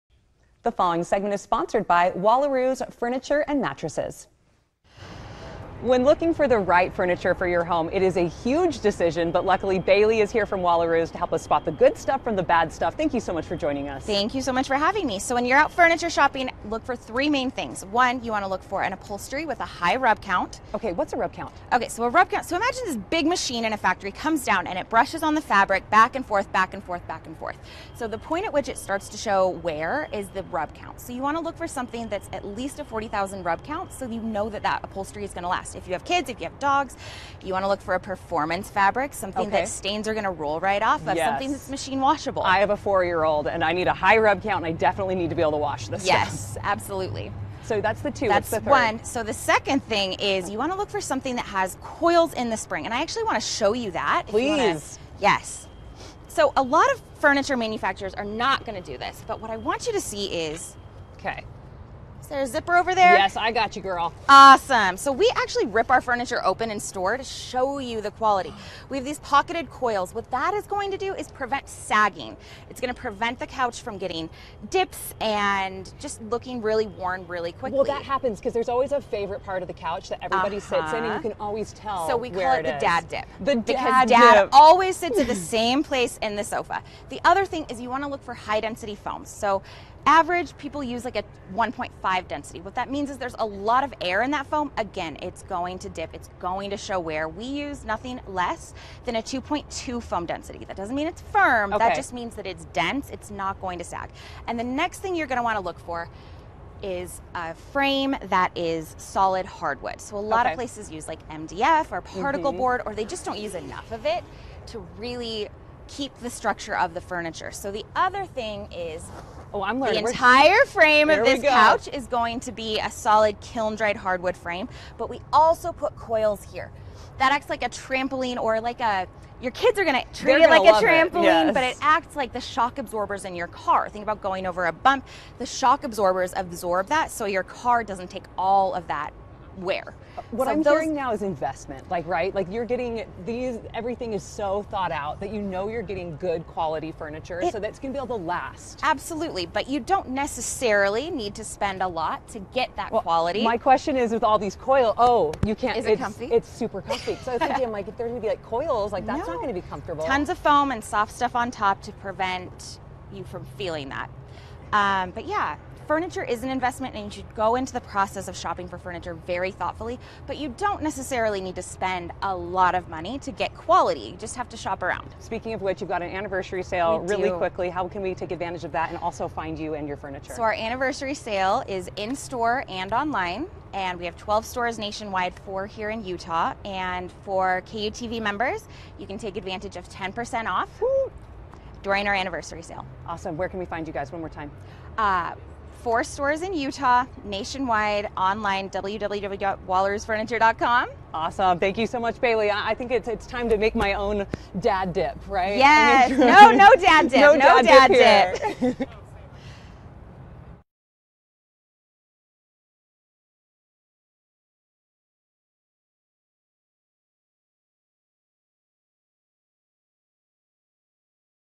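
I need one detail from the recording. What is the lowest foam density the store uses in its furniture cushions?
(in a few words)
2.2.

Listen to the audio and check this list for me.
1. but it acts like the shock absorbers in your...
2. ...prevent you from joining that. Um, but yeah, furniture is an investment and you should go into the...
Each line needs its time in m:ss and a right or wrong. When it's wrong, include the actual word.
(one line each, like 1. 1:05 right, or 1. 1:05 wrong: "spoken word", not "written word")
1. 2:11 right
2. 2:41 wrong: "feeling", not "joining".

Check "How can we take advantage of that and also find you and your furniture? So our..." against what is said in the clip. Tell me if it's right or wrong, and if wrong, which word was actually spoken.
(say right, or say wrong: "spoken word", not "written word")
right.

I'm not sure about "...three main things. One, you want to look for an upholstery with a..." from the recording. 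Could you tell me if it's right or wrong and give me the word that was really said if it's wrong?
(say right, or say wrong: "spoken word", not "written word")
right.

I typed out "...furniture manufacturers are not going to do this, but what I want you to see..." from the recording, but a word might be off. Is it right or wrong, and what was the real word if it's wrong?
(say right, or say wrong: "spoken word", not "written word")
right.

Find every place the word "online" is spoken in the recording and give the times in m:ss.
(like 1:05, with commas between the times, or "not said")
3:02, 3:18.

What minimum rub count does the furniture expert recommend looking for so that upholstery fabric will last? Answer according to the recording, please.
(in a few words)
40,000.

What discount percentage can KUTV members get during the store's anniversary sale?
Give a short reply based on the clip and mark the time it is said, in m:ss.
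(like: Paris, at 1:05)
10%, at 3:09.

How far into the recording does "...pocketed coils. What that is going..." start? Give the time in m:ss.
1:09.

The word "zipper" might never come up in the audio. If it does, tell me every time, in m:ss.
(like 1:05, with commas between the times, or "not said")
1:02.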